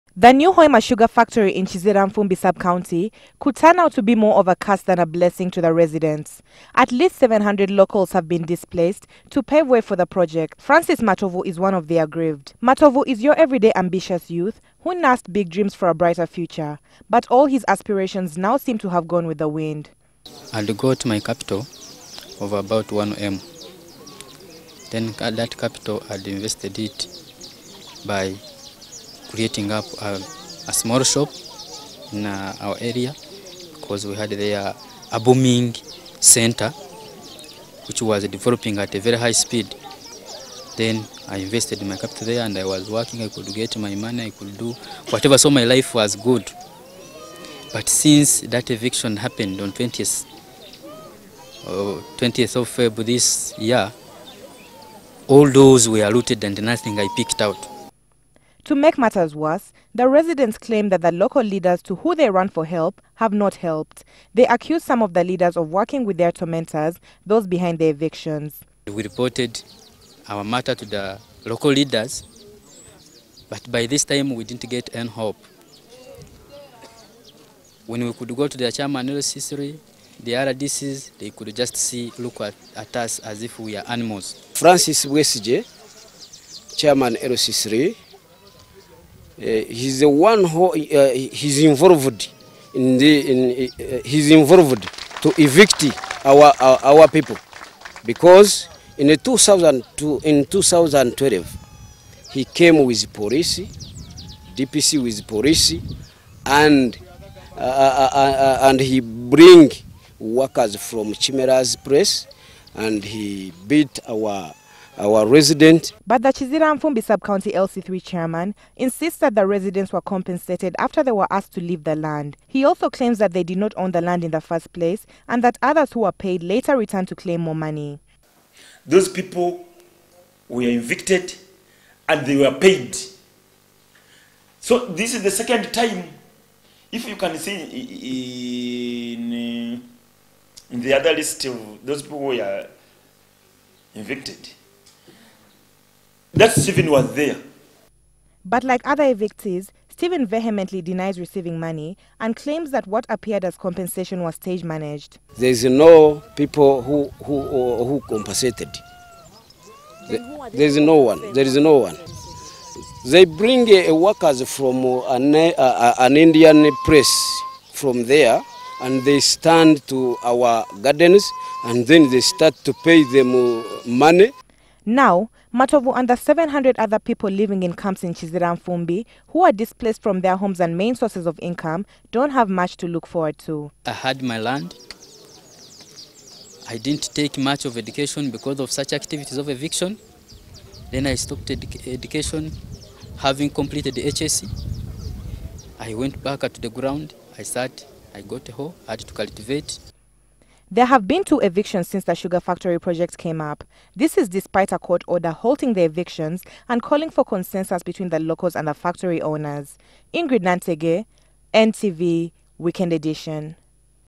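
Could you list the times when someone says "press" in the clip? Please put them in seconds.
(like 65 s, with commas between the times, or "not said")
111 s, 166 s.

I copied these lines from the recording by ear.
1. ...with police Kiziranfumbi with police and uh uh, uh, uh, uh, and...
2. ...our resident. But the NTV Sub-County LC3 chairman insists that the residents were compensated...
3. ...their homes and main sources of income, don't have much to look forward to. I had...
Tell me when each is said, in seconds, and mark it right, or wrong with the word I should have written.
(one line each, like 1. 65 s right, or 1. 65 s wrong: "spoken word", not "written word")
1. 102 s wrong: "DPC", not "Kiziranfumbi"
2. 114 s wrong: "Kiziranfumbi", not "NTV"
3. 180 s right.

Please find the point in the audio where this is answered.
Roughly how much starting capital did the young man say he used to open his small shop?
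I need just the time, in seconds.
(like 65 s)
22 s.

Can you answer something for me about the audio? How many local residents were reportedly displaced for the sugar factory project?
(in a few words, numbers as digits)
700.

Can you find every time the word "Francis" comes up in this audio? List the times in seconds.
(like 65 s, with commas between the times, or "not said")
10 s, 84 s.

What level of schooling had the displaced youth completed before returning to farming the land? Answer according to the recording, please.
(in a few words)
HSC.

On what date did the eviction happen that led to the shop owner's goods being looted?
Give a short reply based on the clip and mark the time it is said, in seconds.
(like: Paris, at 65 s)
20th February, at 52 s.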